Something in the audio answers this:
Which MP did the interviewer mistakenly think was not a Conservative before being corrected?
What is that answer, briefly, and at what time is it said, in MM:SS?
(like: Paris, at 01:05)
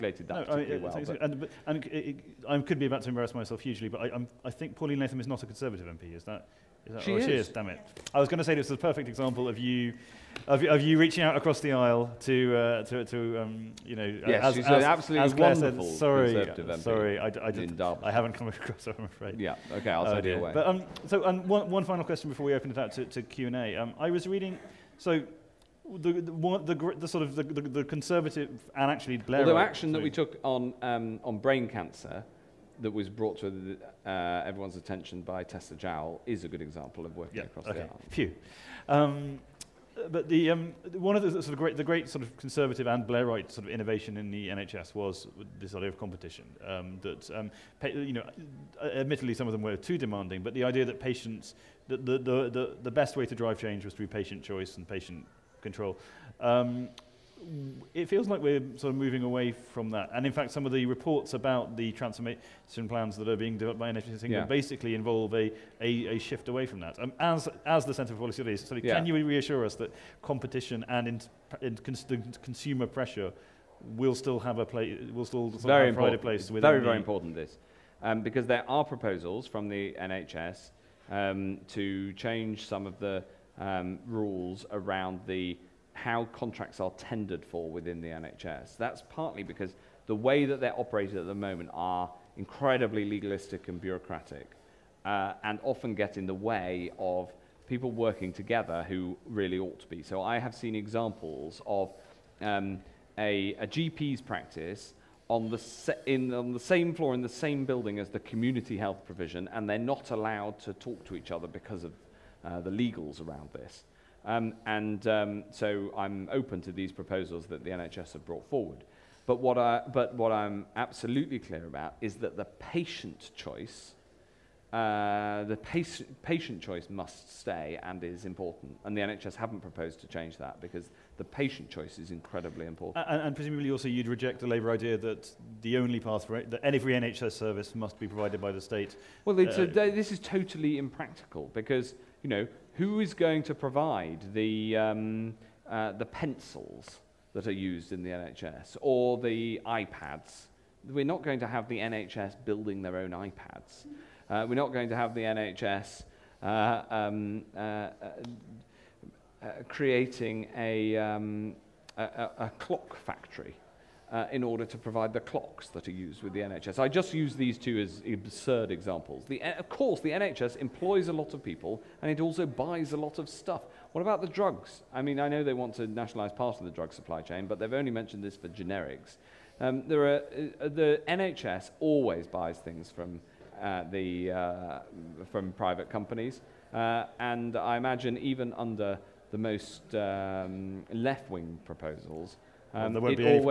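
Pauline Latham, at 00:04.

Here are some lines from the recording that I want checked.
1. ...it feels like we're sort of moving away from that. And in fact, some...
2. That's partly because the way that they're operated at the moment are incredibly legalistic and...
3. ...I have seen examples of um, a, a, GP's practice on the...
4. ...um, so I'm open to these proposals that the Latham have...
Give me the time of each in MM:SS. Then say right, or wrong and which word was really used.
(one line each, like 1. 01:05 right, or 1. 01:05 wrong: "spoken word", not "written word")
1. 00:57 right
2. 01:28 right
3. 01:40 right
4. 01:55 wrong: "NHS", not "Latham".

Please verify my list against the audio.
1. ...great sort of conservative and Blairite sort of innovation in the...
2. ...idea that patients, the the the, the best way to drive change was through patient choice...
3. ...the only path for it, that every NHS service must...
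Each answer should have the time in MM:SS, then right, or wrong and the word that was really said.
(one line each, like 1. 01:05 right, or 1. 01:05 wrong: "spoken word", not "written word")
1. 00:41 right
2. 00:50 right
3. 02:15 right.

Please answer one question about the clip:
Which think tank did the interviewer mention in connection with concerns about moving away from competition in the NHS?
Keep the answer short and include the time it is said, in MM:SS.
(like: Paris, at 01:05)
Centre for Policy Studies, at 01:07.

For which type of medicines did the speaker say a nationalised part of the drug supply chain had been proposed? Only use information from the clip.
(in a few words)
generics.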